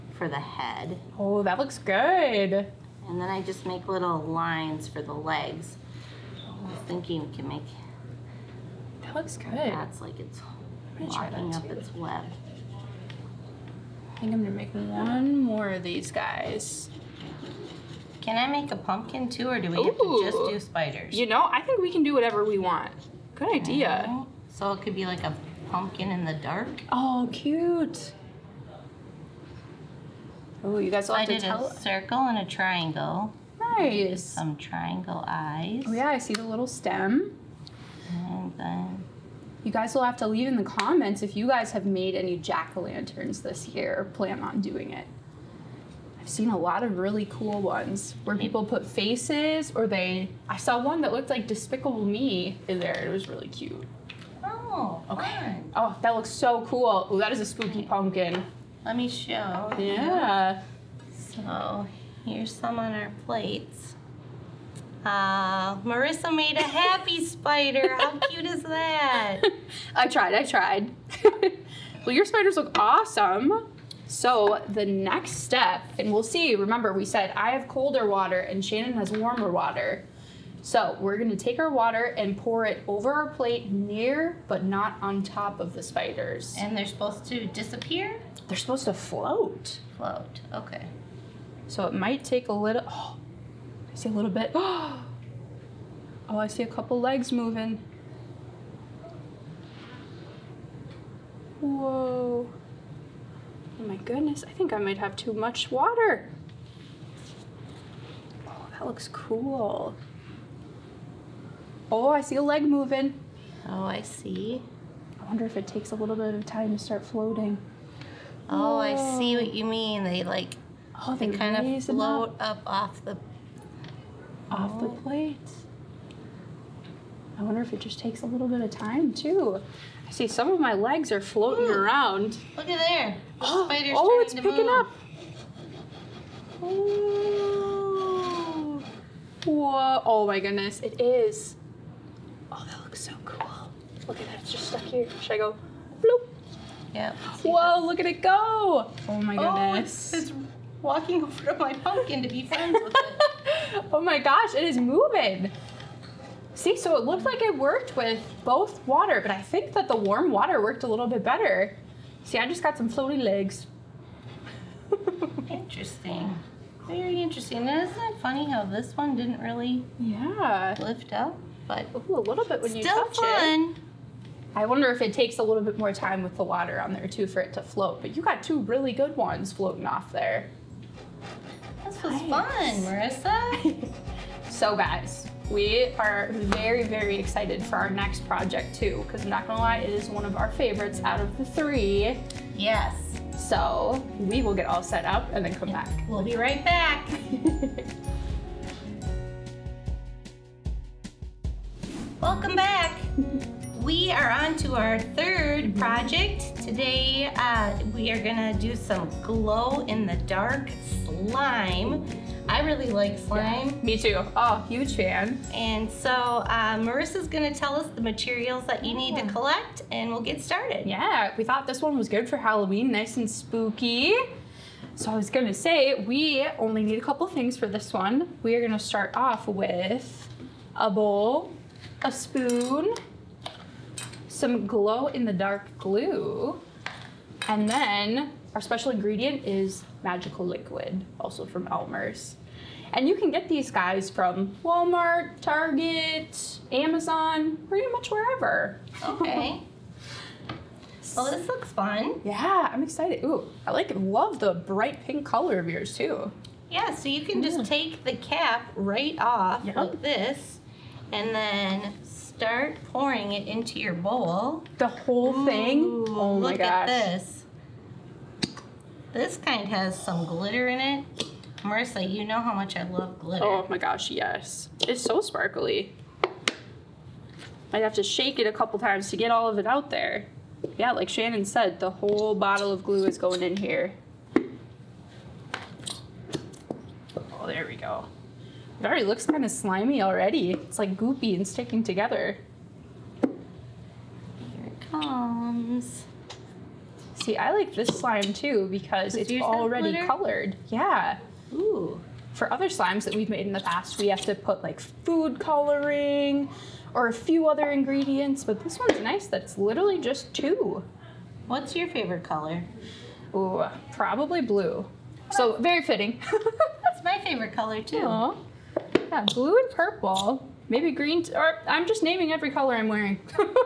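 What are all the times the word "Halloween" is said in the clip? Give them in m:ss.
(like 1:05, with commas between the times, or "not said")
3:42.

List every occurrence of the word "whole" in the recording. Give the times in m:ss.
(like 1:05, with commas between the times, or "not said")
4:24, 4:41.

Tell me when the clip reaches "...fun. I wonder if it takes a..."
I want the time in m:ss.
2:53.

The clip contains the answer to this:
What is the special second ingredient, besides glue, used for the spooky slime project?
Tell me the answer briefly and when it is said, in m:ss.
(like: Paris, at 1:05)
magical liquid, at 4:00.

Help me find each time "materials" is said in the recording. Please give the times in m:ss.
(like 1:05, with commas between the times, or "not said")
3:38.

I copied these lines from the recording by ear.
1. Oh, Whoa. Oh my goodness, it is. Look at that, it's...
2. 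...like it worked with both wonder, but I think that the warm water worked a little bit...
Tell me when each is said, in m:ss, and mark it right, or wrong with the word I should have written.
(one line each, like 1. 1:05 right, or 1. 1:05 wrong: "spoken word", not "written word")
1. 2:16 right
2. 2:37 wrong: "water", not "wonder".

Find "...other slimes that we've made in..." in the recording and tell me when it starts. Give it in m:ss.
5:02.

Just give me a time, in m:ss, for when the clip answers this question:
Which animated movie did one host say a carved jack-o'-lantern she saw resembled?
0:51.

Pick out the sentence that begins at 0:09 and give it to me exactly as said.
That's like it's locking up its web.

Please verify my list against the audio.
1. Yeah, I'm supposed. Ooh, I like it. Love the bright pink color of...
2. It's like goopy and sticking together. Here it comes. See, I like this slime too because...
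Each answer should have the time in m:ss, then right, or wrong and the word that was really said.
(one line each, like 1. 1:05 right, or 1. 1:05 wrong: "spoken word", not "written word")
1. 4:12 wrong: "excited", not "supposed"
2. 4:50 right.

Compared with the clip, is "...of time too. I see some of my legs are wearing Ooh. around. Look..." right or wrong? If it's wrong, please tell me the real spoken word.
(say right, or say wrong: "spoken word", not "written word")
wrong: "floating", not "wearing".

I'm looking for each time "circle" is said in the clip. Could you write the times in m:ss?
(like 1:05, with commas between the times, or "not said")
0:31.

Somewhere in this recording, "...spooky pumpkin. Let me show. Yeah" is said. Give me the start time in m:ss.
0:57.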